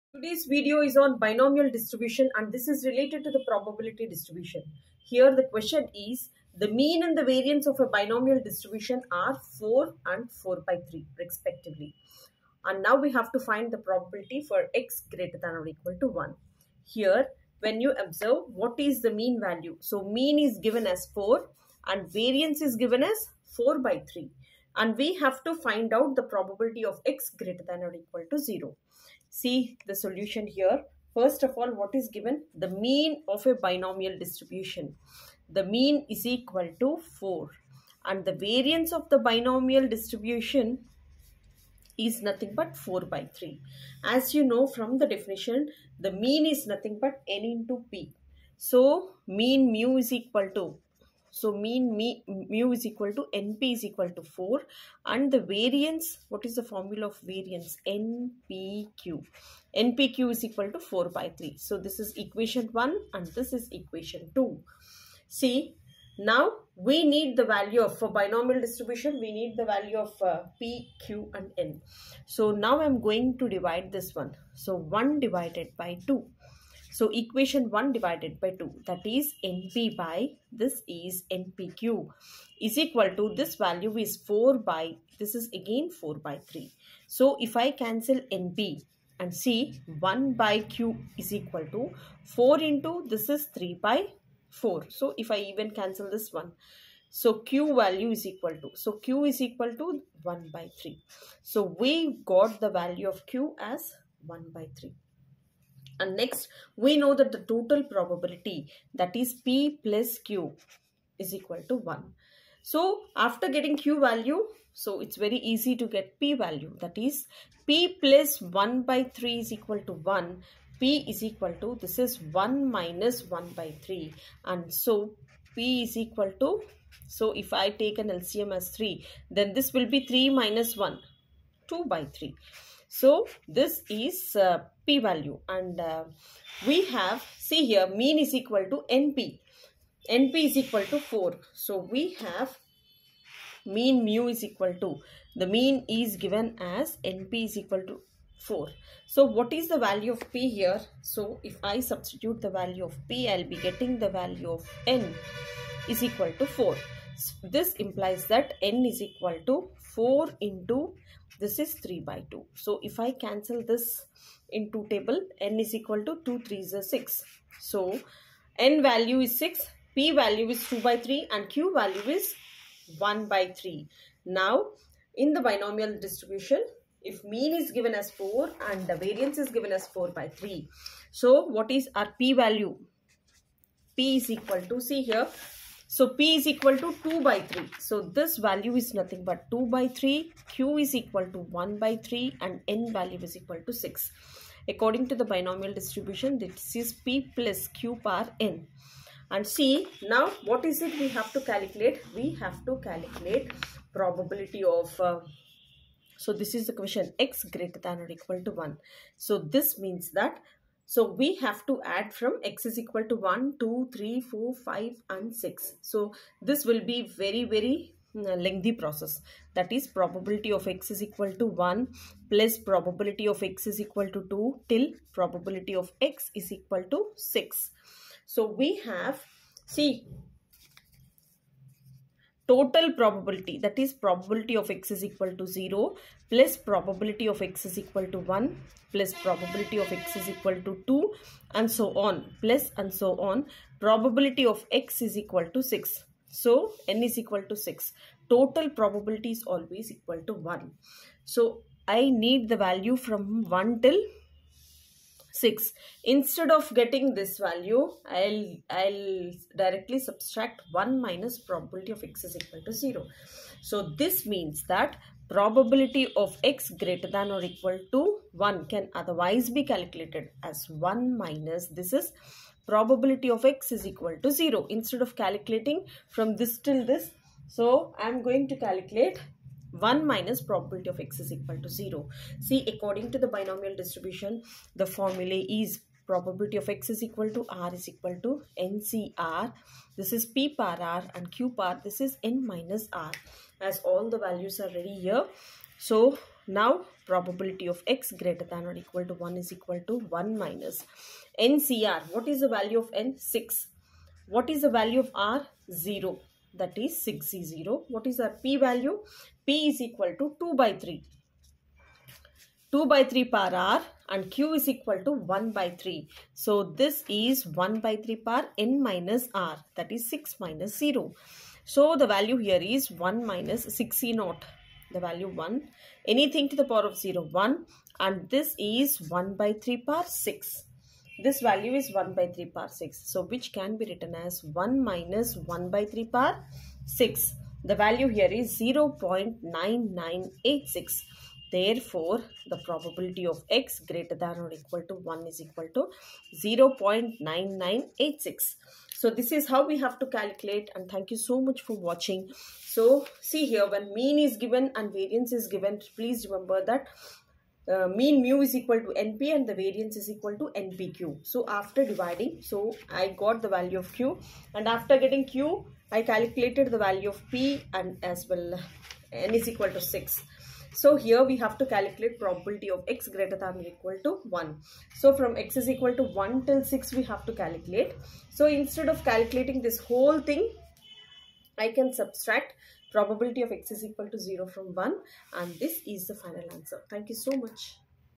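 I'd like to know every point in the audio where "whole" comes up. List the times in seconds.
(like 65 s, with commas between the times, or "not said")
379 s.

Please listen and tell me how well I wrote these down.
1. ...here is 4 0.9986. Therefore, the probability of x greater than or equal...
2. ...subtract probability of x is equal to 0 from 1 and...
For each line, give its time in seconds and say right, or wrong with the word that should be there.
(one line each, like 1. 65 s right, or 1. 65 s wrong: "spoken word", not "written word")
1. 338 s wrong: "0", not "4"
2. 381 s right.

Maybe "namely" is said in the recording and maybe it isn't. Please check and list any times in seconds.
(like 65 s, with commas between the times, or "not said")
not said.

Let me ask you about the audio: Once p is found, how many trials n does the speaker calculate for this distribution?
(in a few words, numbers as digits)
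6.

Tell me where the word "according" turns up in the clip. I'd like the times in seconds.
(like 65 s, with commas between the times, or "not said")
194 s, 282 s.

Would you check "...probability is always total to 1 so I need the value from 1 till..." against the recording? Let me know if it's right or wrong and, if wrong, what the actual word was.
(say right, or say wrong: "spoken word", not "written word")
wrong: "equal", not "total".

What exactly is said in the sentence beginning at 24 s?
And we have to find out the probability of x greater than or equal to 0 see the solution here.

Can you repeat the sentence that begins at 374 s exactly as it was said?
So from x is equal to 1 till 6 we have to calculate.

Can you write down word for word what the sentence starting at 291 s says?
This is n minus r as all the values are ready here.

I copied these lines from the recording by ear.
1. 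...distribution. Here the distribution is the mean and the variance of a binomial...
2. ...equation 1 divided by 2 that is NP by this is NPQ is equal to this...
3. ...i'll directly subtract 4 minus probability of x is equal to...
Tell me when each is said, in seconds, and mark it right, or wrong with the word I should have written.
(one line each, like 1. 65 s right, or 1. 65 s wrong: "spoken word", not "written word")
1. 4 s wrong: "question", not "distribution"
2. 77 s right
3. 258 s wrong: "1", not "4".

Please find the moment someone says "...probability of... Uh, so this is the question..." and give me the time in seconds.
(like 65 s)
203 s.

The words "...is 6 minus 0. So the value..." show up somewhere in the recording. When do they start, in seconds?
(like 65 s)
319 s.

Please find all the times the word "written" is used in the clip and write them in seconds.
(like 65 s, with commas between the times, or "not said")
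333 s.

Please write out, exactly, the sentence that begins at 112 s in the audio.
So, after getting Q value, so it's very easy to get P value.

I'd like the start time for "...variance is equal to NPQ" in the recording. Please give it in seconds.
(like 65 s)
359 s.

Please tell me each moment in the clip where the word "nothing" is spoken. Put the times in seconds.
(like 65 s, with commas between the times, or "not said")
42 s, 46 s, 188 s.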